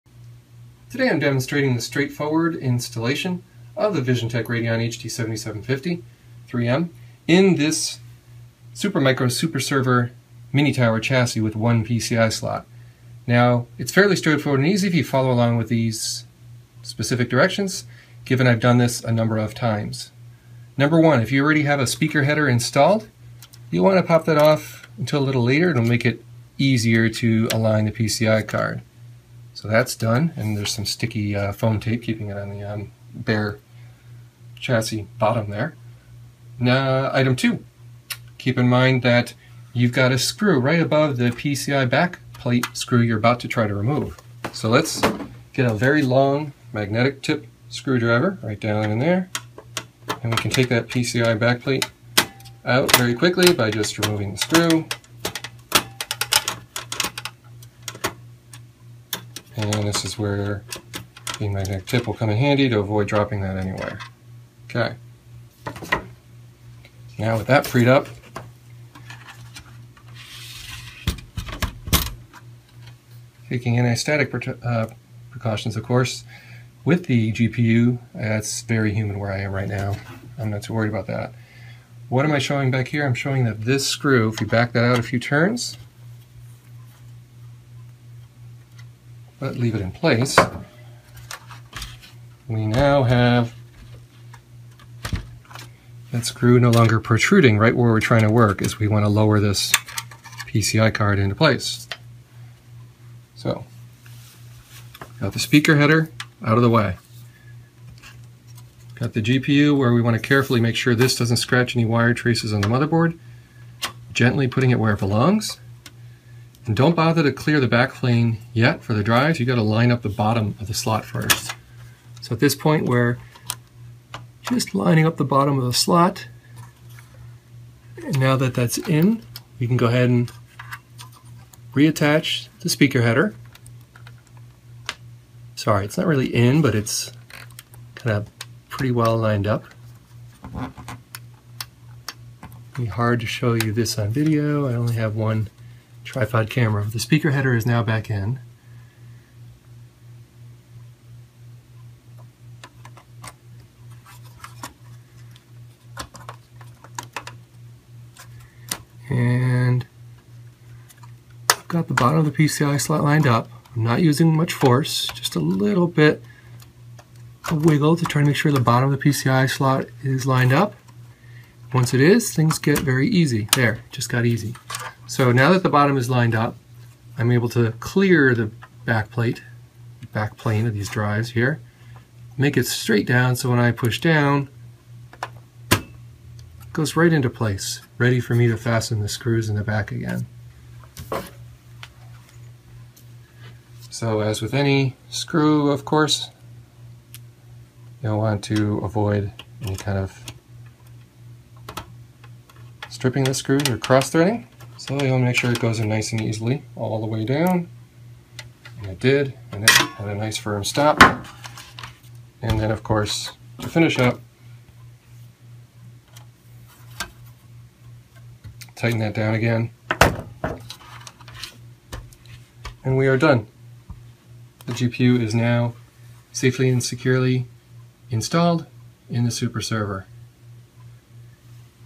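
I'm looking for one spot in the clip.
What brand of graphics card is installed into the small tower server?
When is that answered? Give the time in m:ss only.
0:04.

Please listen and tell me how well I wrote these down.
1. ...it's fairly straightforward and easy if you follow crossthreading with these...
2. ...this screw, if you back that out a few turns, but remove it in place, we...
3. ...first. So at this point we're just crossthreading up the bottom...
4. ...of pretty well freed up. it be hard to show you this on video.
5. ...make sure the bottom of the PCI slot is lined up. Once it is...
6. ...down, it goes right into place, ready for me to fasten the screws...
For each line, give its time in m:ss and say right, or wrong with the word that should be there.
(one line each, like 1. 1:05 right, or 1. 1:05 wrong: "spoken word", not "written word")
1. 0:13 wrong: "along", not "crossthreading"
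2. 1:23 wrong: "leave", not "remove"
3. 2:01 wrong: "lining", not "crossthreading"
4. 2:18 wrong: "lined", not "freed"
5. 2:48 right
6. 3:03 right.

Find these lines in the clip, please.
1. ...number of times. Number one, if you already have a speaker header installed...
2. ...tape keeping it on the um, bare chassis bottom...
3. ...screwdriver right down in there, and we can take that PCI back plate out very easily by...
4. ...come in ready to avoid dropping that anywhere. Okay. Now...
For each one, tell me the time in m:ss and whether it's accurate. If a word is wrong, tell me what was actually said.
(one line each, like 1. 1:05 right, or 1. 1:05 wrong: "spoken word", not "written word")
1. 0:19 right
2. 0:31 right
3. 0:47 wrong: "quickly", not "easily"
4. 1:02 wrong: "handy", not "ready".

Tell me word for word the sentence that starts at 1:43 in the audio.
So, got the speaker header out of the way.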